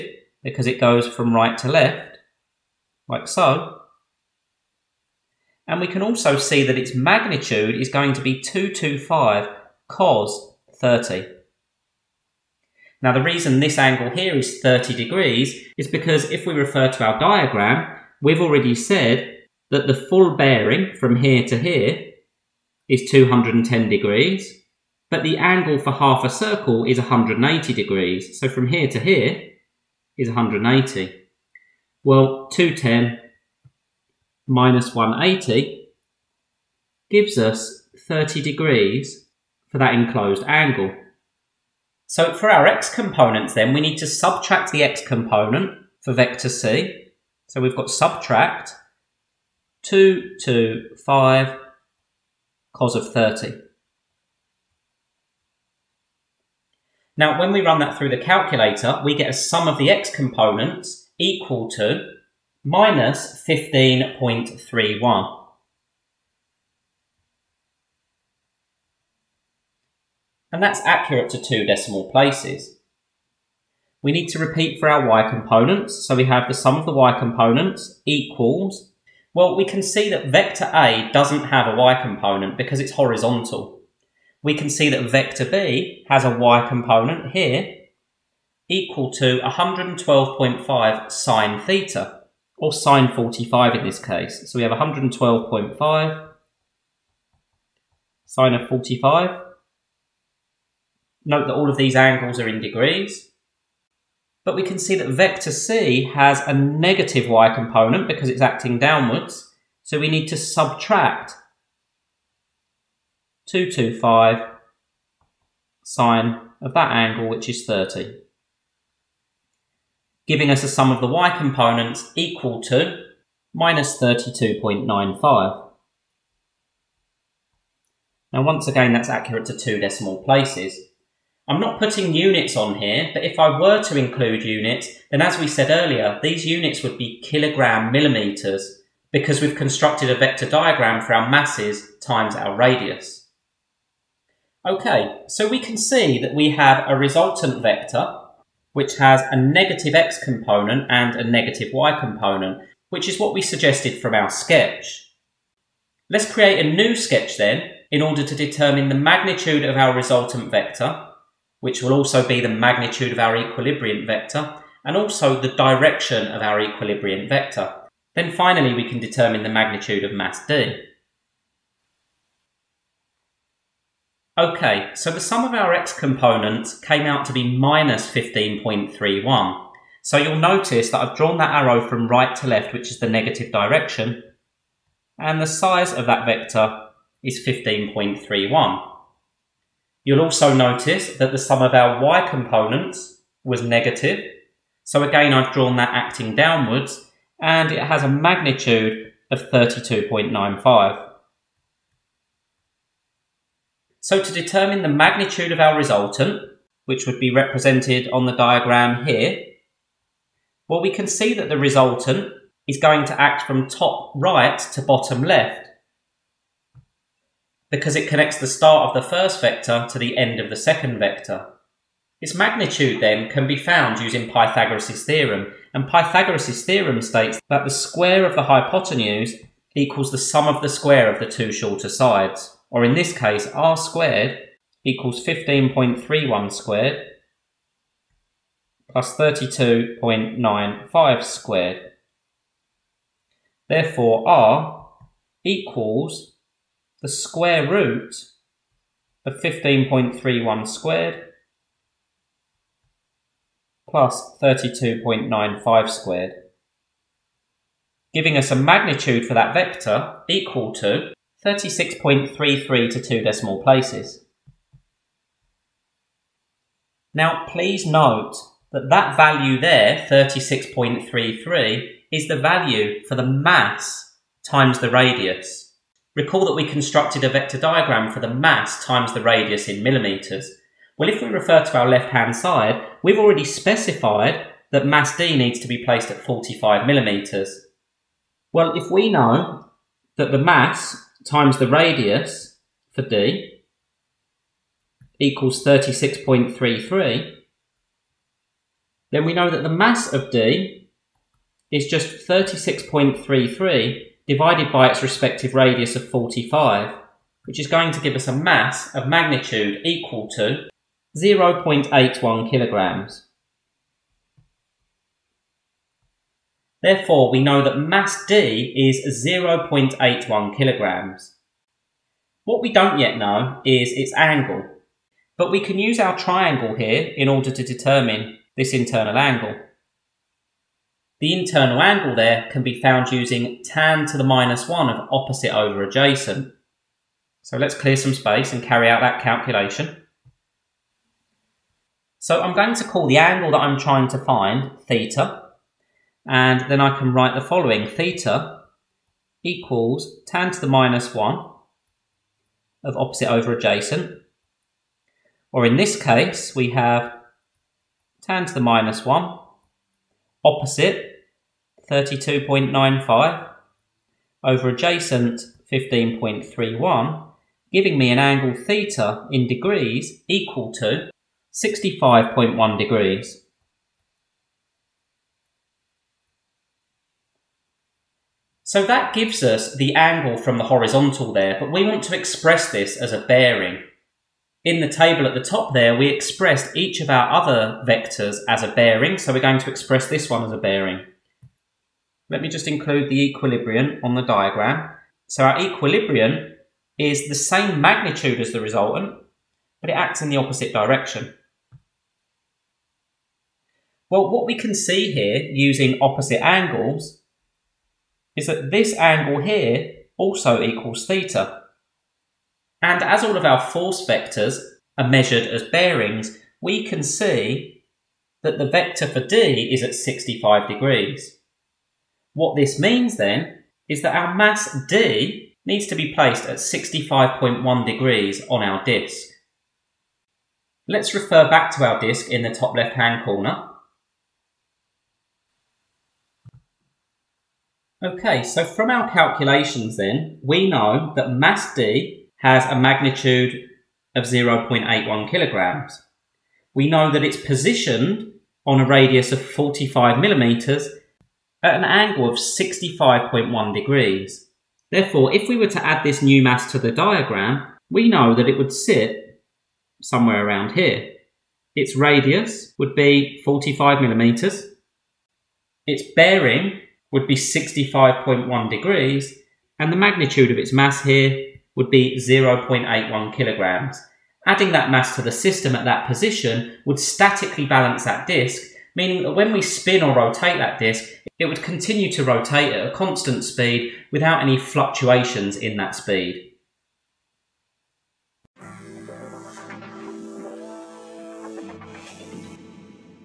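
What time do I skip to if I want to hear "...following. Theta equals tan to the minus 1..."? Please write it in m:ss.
5:47.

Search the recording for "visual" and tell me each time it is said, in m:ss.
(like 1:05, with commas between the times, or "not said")
not said.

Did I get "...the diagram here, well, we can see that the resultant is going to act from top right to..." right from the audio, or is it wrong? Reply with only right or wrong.
right.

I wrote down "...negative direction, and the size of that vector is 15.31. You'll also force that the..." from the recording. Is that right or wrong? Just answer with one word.
wrong.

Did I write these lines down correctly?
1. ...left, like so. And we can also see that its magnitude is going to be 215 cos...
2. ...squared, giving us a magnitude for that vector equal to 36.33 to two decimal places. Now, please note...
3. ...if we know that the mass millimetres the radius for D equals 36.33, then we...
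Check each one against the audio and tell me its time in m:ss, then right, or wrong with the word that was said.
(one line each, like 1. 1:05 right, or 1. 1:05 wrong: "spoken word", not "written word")
1. 0:01 wrong: "225", not "215"
2. 4:15 right
3. 4:48 wrong: "times", not "millimetres".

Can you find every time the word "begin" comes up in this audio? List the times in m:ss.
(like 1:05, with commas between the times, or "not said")
not said.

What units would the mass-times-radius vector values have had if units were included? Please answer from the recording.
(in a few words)
kilogram millimetres.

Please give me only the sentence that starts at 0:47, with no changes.
So we've got subtract 2, 2, 5, cos of 30.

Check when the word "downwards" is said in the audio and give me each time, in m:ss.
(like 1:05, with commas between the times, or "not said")
1:48, 3:16.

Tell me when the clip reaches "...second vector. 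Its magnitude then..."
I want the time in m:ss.
3:40.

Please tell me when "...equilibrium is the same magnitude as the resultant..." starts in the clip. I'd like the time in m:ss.
6:35.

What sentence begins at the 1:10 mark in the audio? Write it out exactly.
And that's accurate to two decimal places.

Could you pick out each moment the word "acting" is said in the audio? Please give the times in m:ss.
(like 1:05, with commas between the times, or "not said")
1:48, 3:15.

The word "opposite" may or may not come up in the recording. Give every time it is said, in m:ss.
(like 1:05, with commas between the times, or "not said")
5:35, 5:52, 6:00, 6:40, 6:46.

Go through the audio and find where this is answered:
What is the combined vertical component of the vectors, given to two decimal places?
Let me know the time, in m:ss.
2:03.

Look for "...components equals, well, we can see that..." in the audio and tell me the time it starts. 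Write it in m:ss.
1:17.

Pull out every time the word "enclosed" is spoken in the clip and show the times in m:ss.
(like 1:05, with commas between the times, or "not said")
0:39.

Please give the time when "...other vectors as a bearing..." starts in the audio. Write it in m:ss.
6:27.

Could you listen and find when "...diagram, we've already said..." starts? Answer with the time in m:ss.
0:17.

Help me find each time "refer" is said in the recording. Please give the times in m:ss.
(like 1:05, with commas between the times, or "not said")
0:16, 4:41, 7:11.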